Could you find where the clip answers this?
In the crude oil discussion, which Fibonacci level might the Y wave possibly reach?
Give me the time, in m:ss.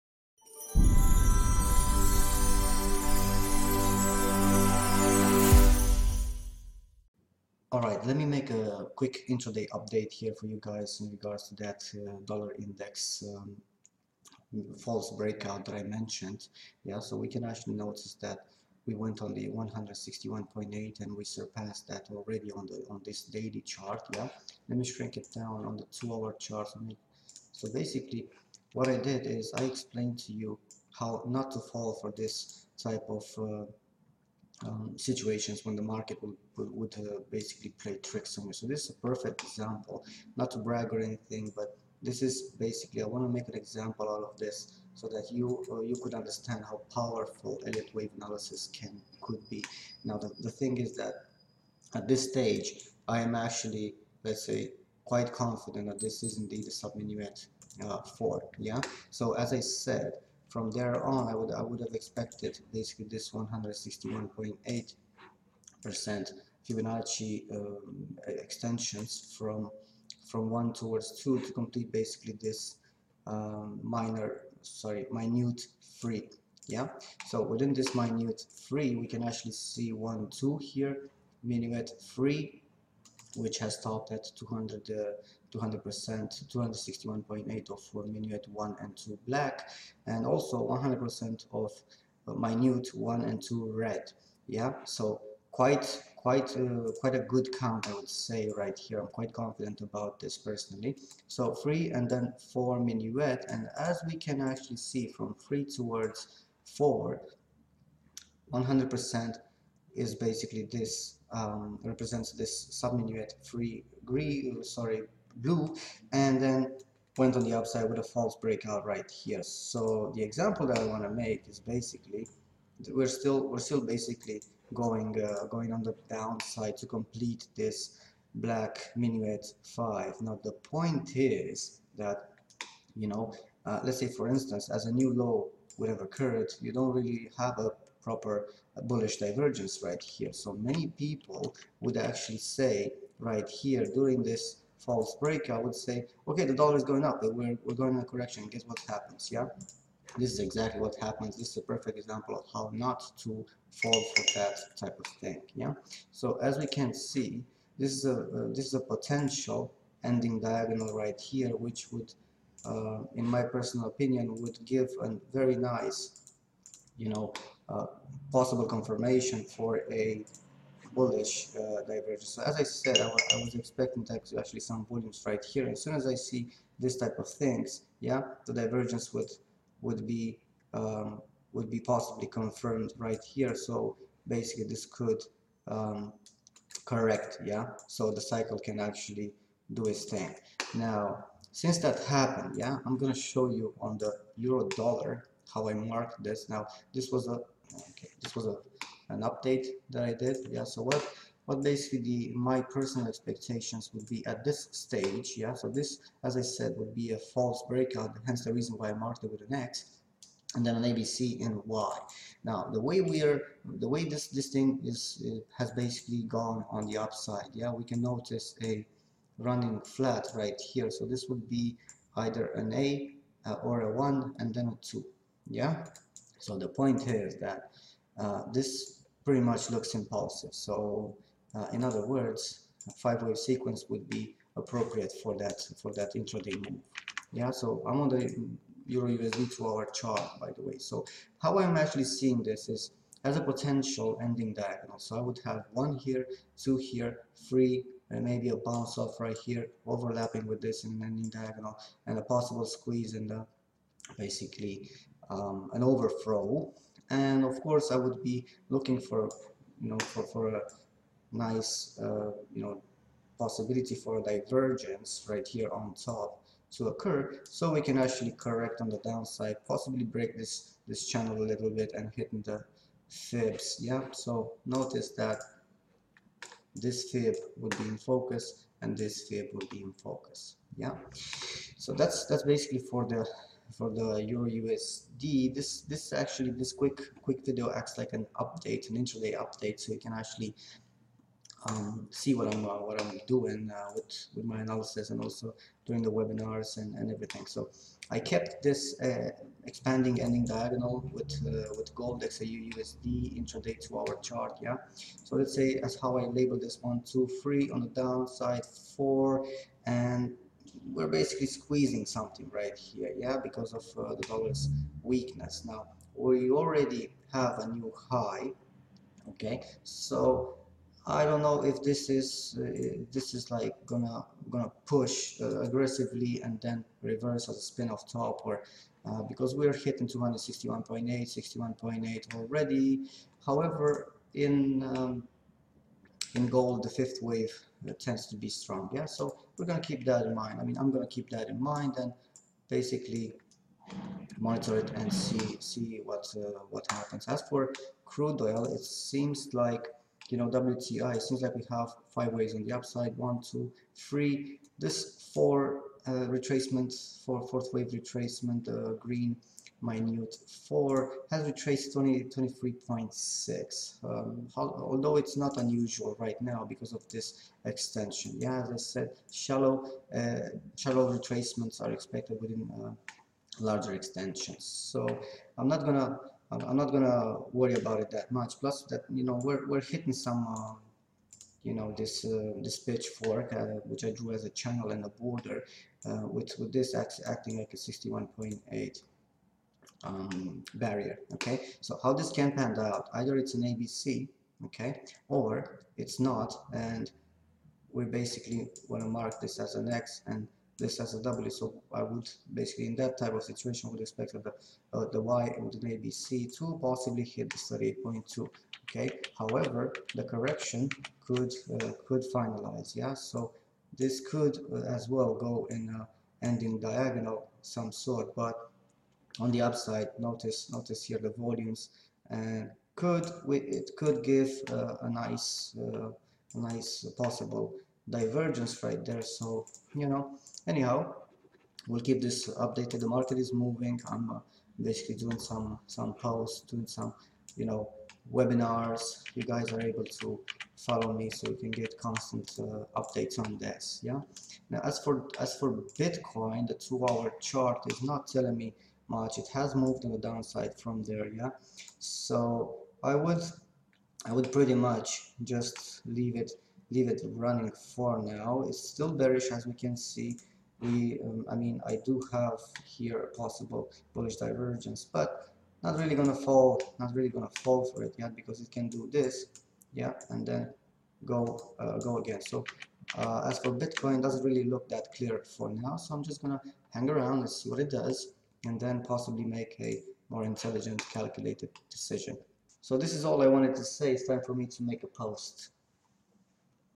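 6:47.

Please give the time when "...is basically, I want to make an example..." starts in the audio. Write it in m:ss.
0:42.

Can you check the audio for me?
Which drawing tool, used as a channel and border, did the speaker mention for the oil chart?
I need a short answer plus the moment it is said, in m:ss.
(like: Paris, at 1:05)
pitchfork, at 6:22.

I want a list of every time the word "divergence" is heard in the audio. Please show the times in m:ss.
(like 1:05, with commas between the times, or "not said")
2:19, 2:51, 2:58, 4:24, 7:08, 7:44.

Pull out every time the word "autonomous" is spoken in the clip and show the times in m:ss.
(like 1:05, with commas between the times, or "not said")
not said.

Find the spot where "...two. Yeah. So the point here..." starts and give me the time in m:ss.
3:44.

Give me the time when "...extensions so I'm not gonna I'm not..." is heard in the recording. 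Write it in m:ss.
6:13.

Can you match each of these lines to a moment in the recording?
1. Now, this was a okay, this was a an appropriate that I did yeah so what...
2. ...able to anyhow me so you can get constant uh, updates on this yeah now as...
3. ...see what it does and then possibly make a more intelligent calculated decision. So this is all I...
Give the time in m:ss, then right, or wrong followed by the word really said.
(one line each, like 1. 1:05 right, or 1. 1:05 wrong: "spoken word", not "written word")
1. 3:16 wrong: "update", not "appropriate"
2. 7:19 wrong: "follow", not "anyhow"
3. 7:57 right.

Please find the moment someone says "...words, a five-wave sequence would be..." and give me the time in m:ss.
3:52.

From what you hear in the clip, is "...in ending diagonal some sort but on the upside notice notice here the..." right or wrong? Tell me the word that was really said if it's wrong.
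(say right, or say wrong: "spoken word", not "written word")
right.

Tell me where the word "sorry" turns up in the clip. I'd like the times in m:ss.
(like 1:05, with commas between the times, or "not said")
1:14, 1:54.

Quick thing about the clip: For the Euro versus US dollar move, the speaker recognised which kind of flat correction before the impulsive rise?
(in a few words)
running flat.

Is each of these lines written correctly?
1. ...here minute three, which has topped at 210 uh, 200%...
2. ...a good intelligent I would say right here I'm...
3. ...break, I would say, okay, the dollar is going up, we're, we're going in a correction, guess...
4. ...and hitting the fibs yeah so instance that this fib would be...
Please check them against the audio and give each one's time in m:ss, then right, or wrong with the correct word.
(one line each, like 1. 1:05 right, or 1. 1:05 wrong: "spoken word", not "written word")
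1. 1:20 wrong: "200", not "210"
2. 1:37 wrong: "count", not "intelligent"
3. 2:25 right
4. 4:31 wrong: "notice", not "instance".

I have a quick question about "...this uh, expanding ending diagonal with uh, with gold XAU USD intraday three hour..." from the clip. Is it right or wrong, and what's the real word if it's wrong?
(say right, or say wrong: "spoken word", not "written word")
wrong: "two", not "three".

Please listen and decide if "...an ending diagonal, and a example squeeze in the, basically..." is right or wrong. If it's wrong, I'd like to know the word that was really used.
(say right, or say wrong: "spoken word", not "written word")
wrong: "possible", not "example".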